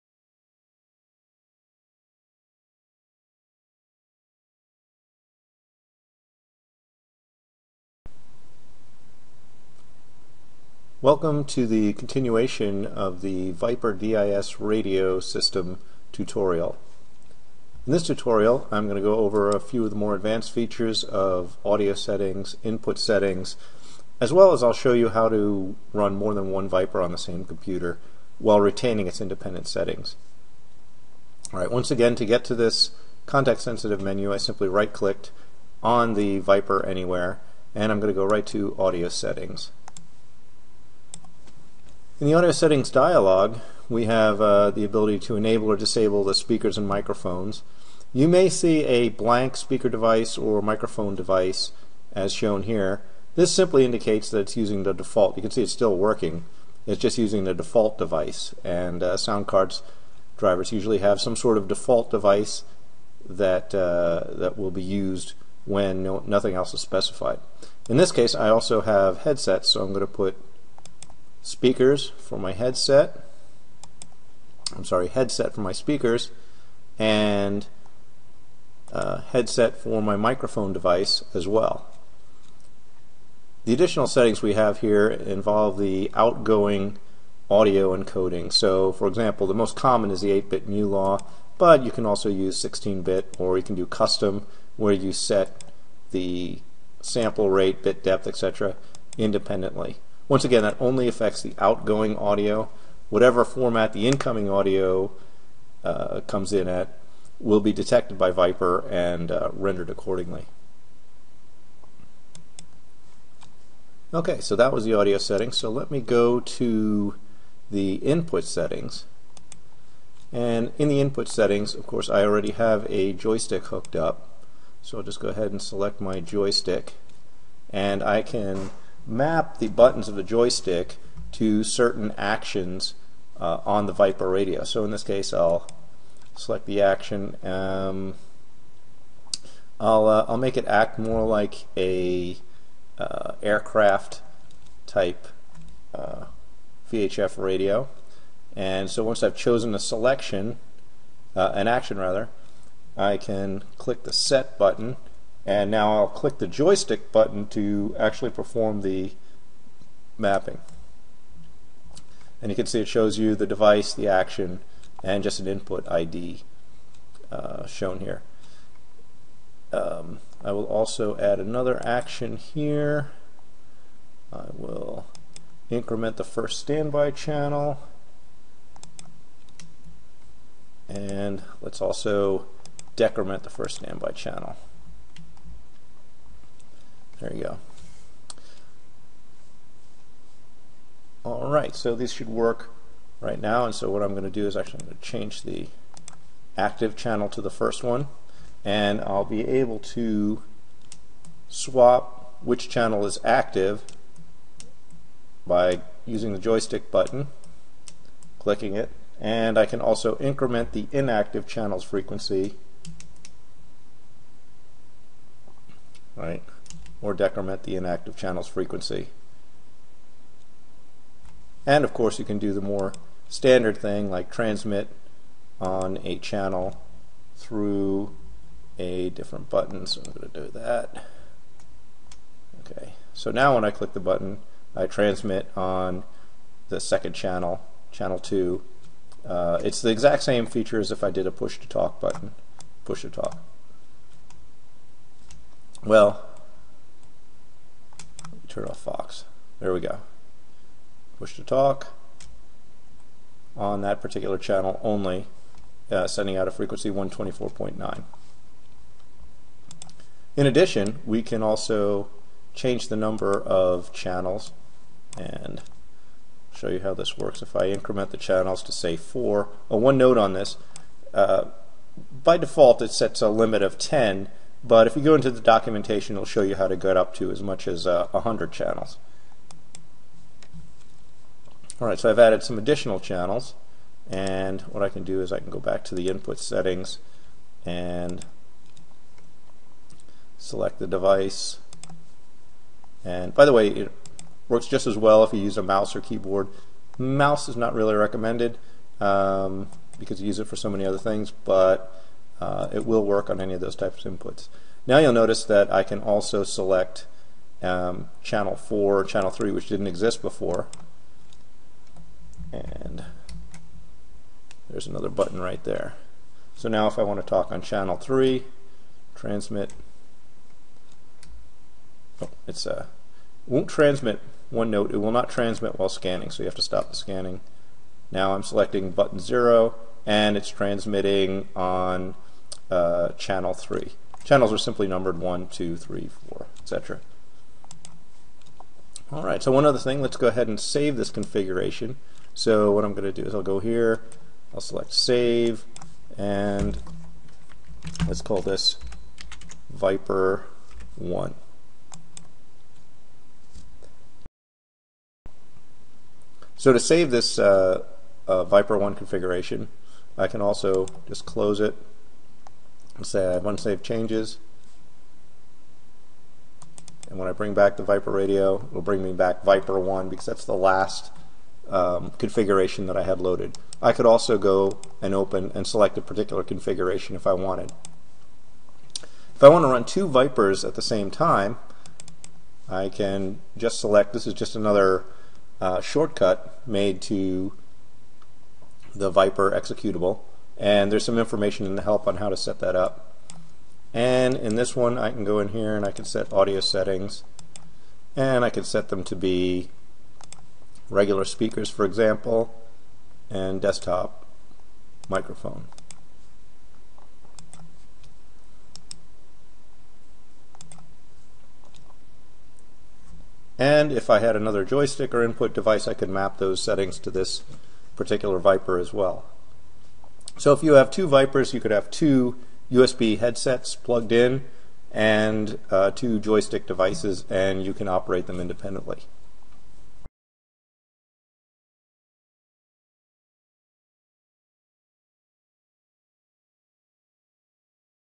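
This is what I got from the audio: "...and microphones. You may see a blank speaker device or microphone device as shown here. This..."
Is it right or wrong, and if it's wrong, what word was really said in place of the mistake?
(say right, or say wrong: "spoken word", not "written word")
right.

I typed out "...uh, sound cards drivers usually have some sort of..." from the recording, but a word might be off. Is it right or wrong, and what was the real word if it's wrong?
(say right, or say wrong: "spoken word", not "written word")
right.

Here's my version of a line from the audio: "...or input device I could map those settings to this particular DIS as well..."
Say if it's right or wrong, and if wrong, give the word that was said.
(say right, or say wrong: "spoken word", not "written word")
wrong: "Viper", not "DIS".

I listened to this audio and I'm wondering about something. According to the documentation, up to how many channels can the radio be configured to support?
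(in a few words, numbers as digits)
100.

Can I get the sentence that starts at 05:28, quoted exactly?
Now I'm selecting button 0, and it's transmitting on uh, channel 3.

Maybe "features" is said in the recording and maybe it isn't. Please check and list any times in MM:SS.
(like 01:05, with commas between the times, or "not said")
00:20, 04:00.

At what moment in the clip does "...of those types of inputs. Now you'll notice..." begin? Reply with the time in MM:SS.
05:03.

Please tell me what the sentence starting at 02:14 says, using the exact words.
So in this case, I'll select the action.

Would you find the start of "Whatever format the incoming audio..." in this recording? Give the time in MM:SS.
01:43.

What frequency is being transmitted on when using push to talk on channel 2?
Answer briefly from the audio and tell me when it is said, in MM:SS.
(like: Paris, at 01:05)
124.9, at 04:16.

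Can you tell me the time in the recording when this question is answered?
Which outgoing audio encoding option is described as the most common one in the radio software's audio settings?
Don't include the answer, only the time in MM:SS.
01:30.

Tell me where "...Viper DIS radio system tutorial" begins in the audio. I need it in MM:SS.
00:13.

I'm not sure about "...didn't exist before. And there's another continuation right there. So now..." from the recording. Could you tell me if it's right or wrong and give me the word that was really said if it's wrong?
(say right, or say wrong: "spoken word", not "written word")
wrong: "button", not "continuation".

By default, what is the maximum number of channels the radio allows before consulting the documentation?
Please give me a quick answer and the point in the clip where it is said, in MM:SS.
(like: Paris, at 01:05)
10, at 04:33.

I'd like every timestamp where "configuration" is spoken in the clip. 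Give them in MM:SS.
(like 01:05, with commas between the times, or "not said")
05:41, 05:58, 06:12, 06:16.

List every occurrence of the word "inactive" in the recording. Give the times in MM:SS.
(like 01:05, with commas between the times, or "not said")
03:30, 03:37.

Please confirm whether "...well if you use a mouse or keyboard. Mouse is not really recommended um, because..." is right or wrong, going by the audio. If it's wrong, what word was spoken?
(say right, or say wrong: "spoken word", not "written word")
right.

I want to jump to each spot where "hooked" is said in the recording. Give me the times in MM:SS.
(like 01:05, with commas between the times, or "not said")
02:03.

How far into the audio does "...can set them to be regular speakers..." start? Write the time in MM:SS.
06:38.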